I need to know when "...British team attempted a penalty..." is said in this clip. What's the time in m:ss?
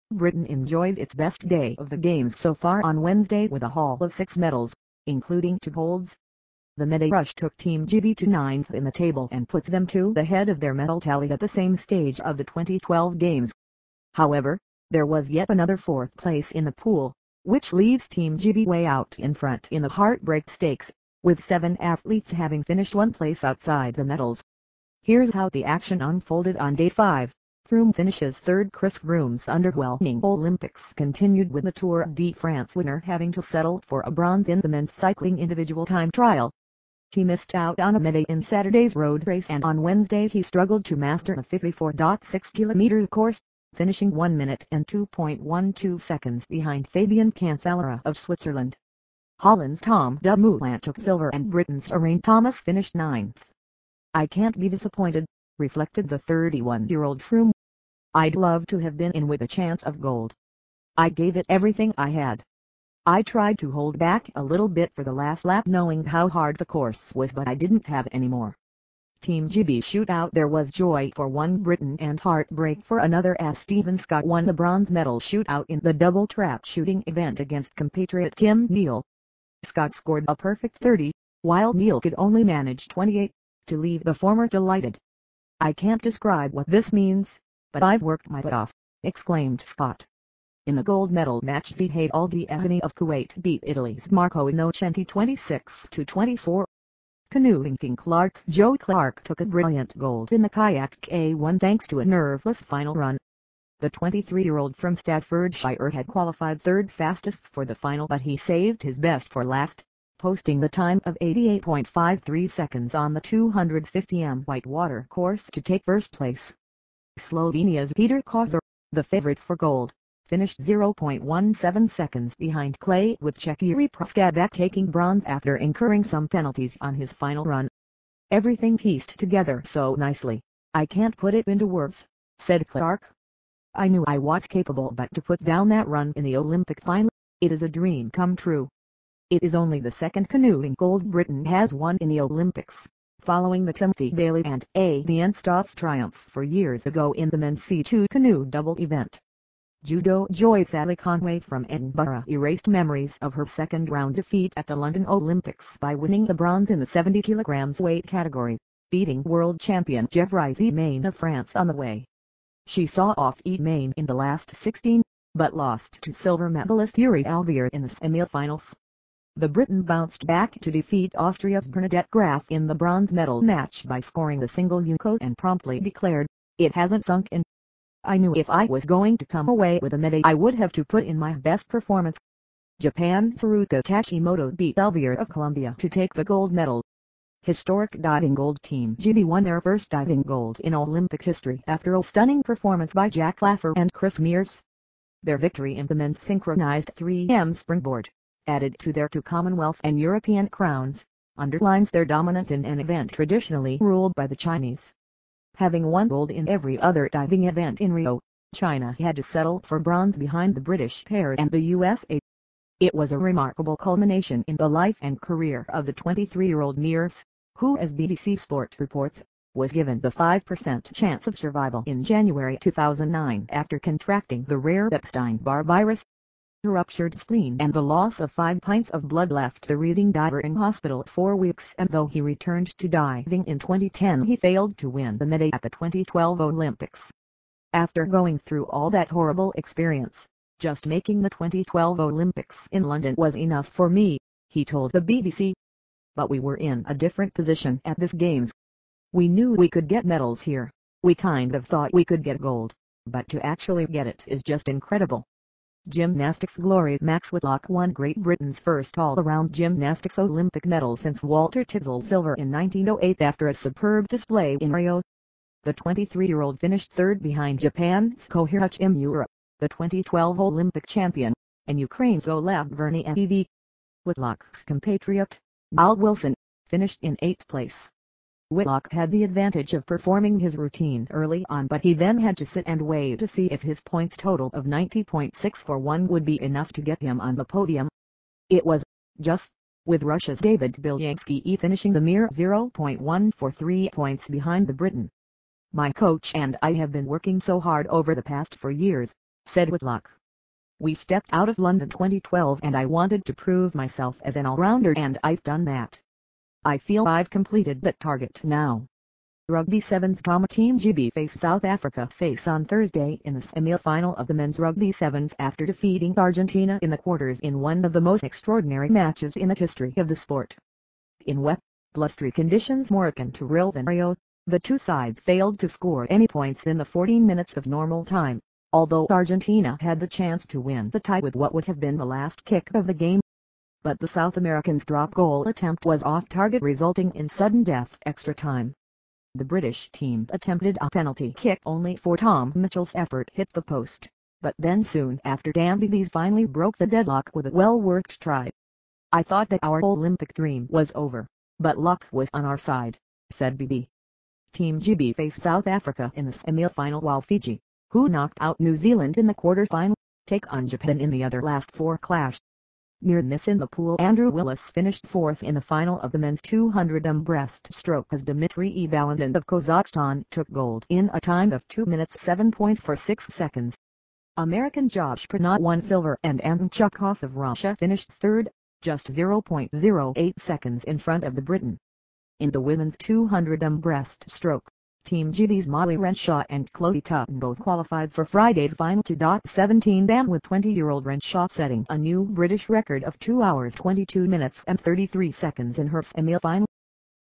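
5:39.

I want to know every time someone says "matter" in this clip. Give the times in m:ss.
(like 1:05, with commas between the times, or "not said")
not said.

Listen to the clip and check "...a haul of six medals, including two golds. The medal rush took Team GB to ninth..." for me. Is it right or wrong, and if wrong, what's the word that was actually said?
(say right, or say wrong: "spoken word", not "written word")
right.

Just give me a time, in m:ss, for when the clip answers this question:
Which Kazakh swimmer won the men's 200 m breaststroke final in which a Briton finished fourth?
6:08.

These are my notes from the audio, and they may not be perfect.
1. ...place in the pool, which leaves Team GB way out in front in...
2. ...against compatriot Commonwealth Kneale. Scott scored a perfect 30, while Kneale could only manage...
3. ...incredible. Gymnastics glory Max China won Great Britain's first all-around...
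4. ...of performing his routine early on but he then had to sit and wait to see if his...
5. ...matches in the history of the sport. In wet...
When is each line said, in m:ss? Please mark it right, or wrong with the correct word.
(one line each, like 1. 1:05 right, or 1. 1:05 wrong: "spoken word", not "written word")
1. 0:16 right
2. 1:17 wrong: "Tim", not "Commonwealth"
3. 4:14 wrong: "Whitlock", not "China"
4. 4:39 right
5. 5:18 right.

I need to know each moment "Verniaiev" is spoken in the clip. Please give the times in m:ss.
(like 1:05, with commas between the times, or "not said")
4:32.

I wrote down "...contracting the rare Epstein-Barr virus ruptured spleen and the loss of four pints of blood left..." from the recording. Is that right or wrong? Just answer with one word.
wrong.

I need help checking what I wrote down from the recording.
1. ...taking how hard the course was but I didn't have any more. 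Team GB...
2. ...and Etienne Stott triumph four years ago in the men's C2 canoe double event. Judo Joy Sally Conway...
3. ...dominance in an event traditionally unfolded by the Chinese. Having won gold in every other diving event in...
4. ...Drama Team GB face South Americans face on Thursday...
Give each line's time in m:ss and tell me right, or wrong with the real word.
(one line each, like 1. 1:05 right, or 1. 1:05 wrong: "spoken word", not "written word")
1. 1:05 wrong: "knowing", not "taking"
2. 2:24 right
3. 3:22 wrong: "ruled", not "unfolded"
4. 5:10 wrong: "Africa", not "Americans".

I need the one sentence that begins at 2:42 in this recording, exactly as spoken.
She saw off Emain in the last 16, but lost to silver medalist Yuri Alvear in the semifinals.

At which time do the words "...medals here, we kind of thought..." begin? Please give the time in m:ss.
4:10.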